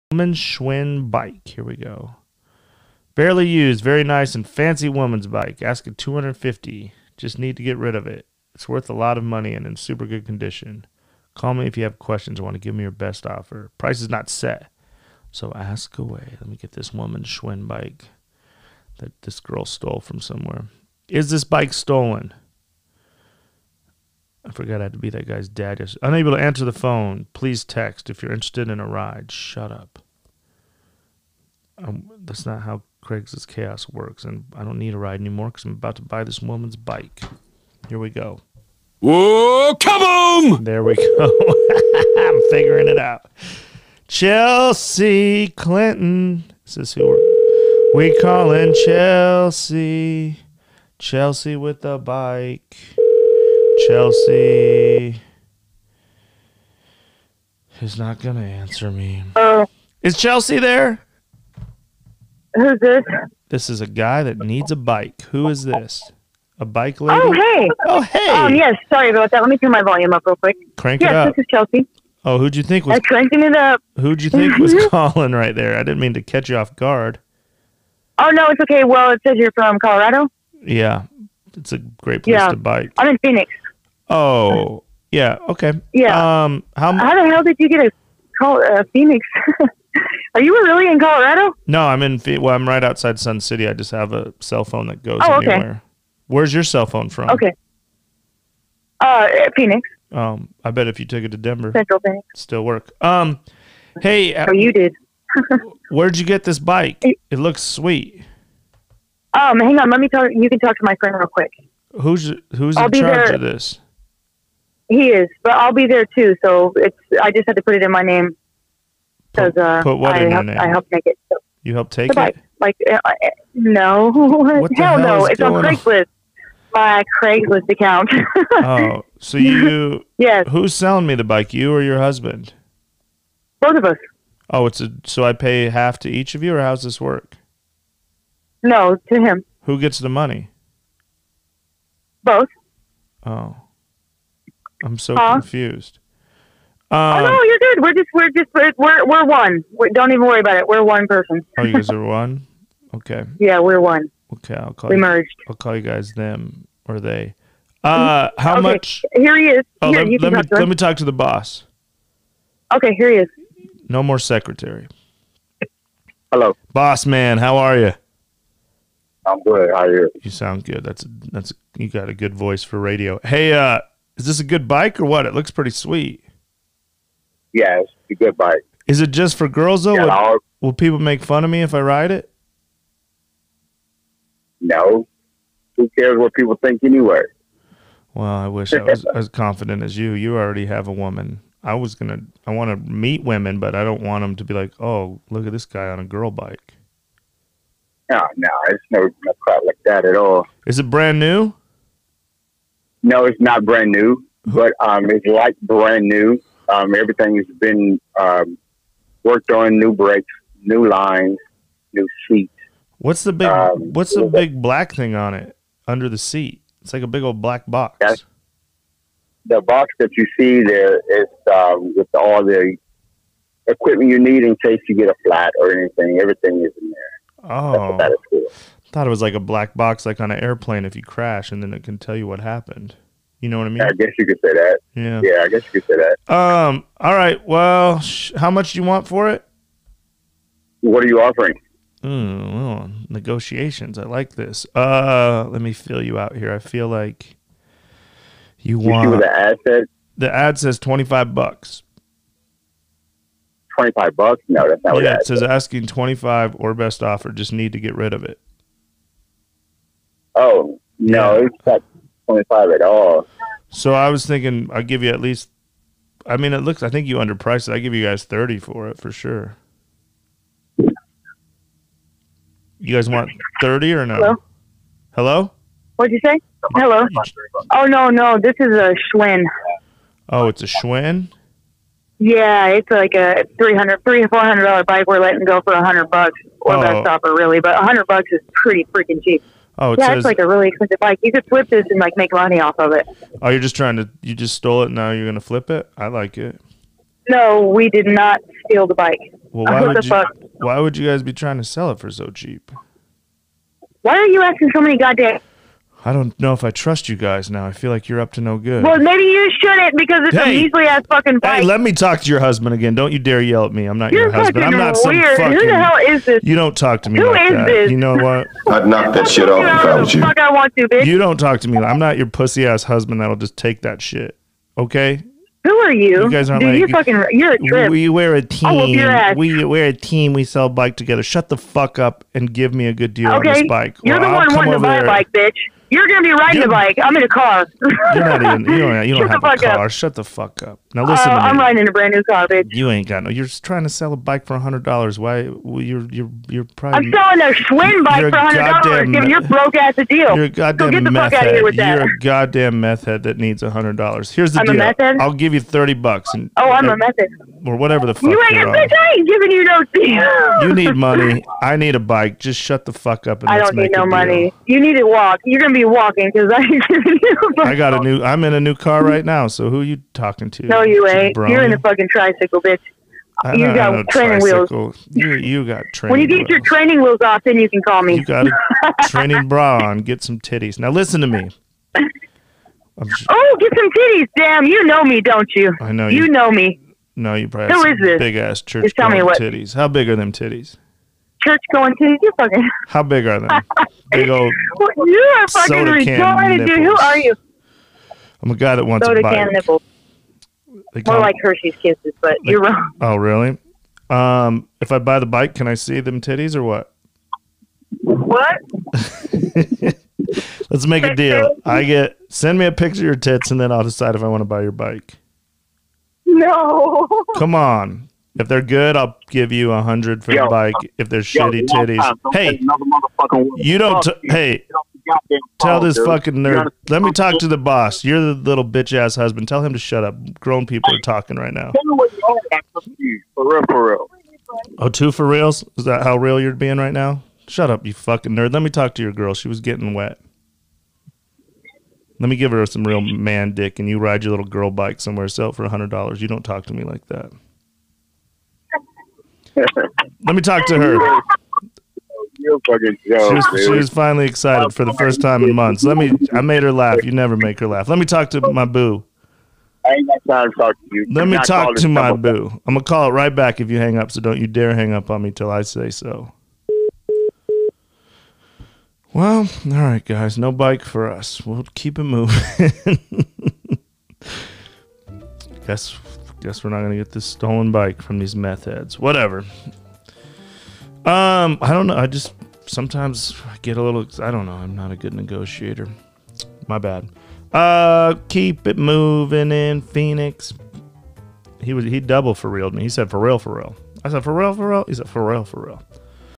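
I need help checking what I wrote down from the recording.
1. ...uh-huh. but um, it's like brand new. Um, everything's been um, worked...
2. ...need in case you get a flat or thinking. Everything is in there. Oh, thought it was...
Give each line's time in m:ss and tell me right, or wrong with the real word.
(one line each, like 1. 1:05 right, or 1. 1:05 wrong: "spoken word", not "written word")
1. 3:24 right
2. 3:44 wrong: "anything", not "thinking".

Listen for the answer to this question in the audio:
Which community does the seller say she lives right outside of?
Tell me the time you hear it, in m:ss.
1:33.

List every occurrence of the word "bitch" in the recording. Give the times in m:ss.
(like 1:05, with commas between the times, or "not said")
5:20, 5:35, 5:42, 5:58, 6:12, 7:08.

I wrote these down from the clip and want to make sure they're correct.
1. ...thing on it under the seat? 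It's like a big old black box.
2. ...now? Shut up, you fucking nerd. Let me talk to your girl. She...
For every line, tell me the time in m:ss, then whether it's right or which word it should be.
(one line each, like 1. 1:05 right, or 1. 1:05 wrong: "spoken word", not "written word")
1. 3:34 right
2. 7:16 right.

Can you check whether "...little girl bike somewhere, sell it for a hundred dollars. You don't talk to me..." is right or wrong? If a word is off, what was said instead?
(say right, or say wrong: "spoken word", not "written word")
right.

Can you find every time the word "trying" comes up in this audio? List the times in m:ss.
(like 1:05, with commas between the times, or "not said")
4:53, 5:01, 5:43.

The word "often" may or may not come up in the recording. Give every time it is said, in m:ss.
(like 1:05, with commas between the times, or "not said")
not said.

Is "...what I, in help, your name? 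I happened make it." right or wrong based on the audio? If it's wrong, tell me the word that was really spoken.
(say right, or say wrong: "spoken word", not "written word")
wrong: "helped", not "happened".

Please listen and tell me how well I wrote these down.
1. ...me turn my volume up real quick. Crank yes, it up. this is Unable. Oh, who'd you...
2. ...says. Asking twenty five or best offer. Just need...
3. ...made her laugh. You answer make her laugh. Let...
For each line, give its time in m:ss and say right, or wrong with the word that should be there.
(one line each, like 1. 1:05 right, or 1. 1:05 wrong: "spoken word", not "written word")
1. 1:09 wrong: "Chelsea", not "Unable"
2. 4:15 right
3. 7:36 wrong: "never", not "answer".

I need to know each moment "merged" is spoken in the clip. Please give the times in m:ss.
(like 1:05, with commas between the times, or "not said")
2:35.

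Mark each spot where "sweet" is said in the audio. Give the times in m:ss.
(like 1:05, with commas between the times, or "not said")
1:47, 2:55.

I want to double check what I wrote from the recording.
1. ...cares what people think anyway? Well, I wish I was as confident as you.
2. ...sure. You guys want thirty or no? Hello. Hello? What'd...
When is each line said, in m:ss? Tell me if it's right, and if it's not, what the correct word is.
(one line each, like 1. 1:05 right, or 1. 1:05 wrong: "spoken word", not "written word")
1. 3:05 right
2. 4:29 right.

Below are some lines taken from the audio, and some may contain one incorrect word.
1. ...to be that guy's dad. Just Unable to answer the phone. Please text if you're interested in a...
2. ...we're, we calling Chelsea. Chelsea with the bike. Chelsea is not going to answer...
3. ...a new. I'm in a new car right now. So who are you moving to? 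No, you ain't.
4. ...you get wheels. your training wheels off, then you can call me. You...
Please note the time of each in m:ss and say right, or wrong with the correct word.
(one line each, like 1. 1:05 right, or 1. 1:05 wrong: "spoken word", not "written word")
1. 0:24 right
2. 0:47 right
3. 6:07 wrong: "talking", not "moving"
4. 6:16 right.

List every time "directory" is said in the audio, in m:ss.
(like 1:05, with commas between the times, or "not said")
not said.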